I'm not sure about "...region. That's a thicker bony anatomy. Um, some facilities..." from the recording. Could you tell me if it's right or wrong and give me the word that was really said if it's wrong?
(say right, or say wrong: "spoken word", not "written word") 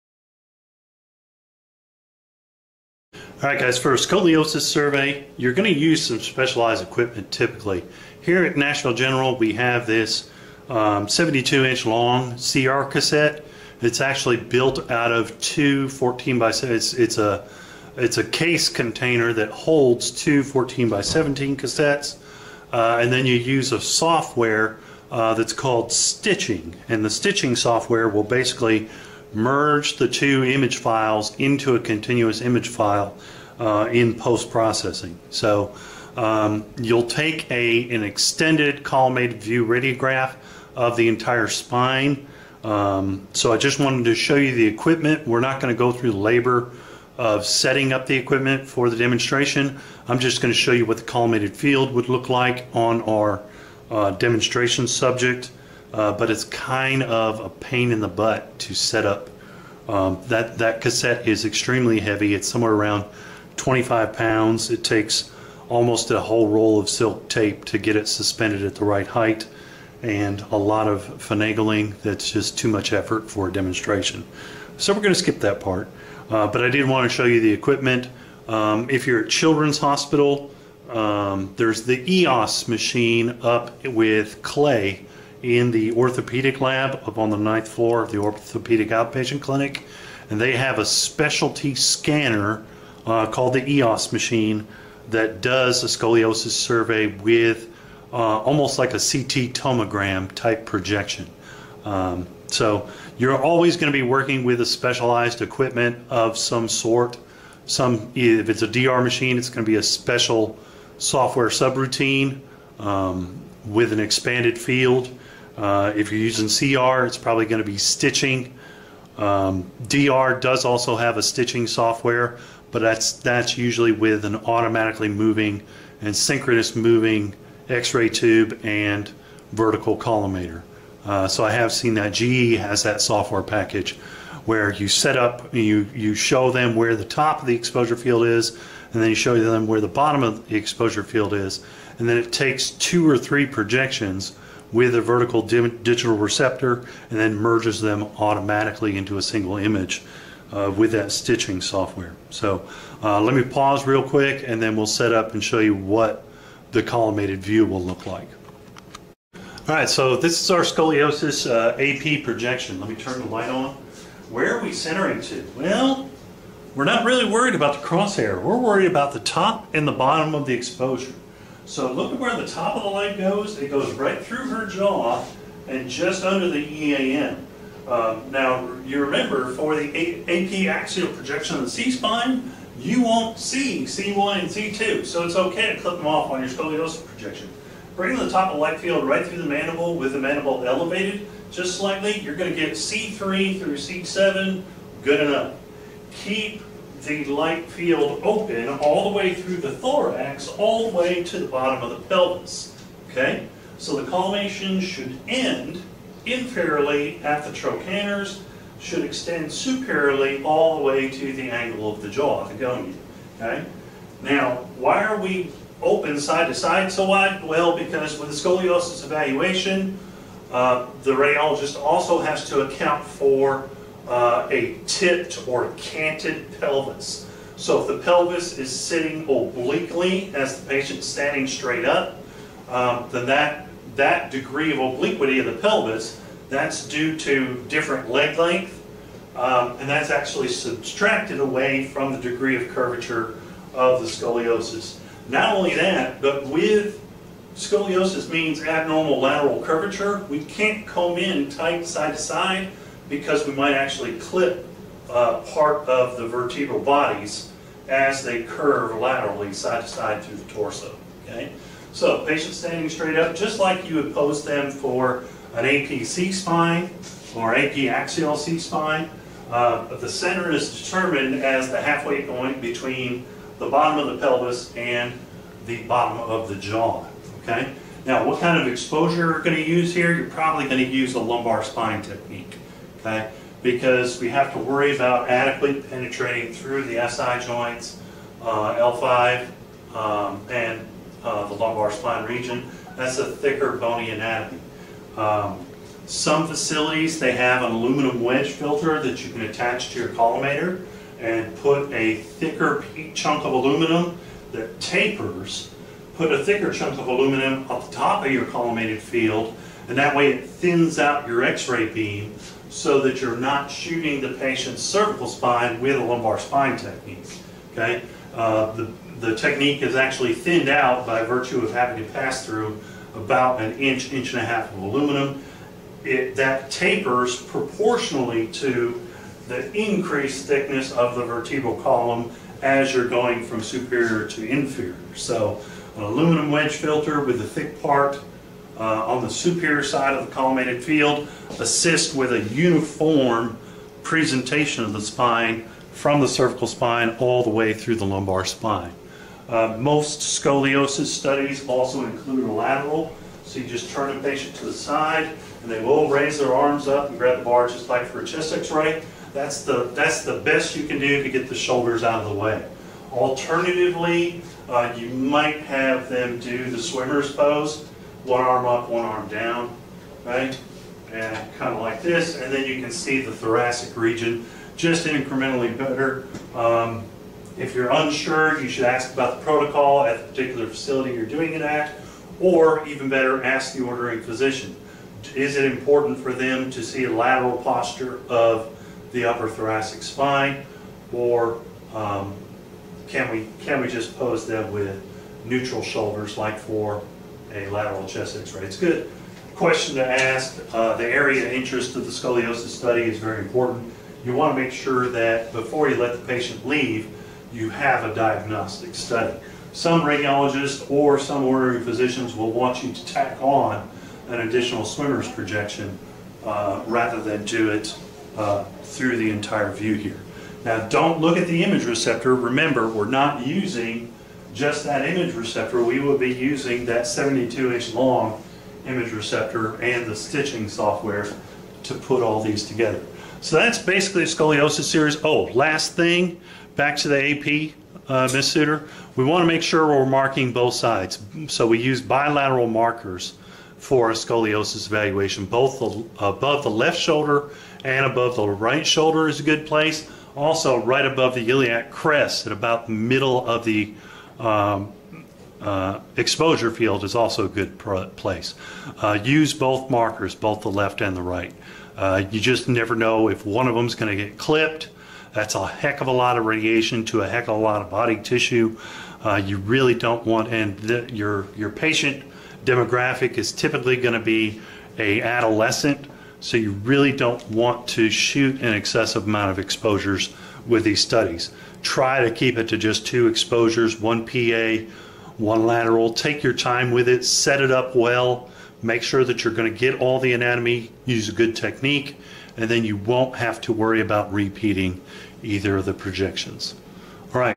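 right.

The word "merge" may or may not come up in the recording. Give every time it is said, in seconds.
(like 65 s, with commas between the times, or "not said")
29 s, 147 s.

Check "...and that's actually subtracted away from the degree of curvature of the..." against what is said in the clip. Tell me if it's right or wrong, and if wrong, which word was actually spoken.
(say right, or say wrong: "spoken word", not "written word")
right.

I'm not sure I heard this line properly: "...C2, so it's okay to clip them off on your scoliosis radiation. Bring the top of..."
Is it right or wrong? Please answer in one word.
wrong.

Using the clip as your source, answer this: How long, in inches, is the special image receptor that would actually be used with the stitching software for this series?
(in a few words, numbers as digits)
72.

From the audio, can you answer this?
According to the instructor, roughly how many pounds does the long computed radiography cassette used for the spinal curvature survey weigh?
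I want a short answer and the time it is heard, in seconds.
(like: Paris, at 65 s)
25, at 63 s.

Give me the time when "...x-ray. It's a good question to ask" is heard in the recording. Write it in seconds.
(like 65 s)
398 s.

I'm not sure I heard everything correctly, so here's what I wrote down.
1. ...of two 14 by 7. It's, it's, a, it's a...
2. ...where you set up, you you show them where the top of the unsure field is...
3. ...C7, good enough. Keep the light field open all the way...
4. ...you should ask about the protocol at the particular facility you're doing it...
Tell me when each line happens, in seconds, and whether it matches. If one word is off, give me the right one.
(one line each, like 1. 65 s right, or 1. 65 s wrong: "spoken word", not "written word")
1. 15 s right
2. 134 s wrong: "exposure", not "unsure"
3. 193 s right
4. 378 s right.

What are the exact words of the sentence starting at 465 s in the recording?
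That's a heck of a lot of radiation to a heck of a lot of body tissue.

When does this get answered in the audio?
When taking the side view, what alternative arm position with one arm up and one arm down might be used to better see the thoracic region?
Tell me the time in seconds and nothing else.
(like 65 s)
366 s.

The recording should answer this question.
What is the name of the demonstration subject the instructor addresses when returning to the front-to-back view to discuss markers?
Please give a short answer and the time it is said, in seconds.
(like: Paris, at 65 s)
Ms. Suter, at 438 s.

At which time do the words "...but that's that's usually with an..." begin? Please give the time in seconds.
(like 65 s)
122 s.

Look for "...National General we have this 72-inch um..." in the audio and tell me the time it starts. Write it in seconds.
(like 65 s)
8 s.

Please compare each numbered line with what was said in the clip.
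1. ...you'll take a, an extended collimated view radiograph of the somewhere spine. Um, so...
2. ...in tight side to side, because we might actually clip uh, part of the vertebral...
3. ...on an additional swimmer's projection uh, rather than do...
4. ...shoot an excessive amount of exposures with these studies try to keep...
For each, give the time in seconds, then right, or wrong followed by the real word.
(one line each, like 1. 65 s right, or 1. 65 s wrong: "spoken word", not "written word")
1. 36 s wrong: "entire", not "somewhere"
2. 251 s right
3. 413 s right
4. 478 s right.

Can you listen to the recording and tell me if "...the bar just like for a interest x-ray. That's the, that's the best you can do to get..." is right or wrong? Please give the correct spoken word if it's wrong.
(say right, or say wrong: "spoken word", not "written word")
wrong: "chest", not "interest".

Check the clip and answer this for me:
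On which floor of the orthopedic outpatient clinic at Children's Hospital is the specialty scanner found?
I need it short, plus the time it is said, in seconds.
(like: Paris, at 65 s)
ninth floor, at 87 s.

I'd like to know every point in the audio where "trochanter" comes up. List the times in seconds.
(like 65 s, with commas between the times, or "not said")
207 s.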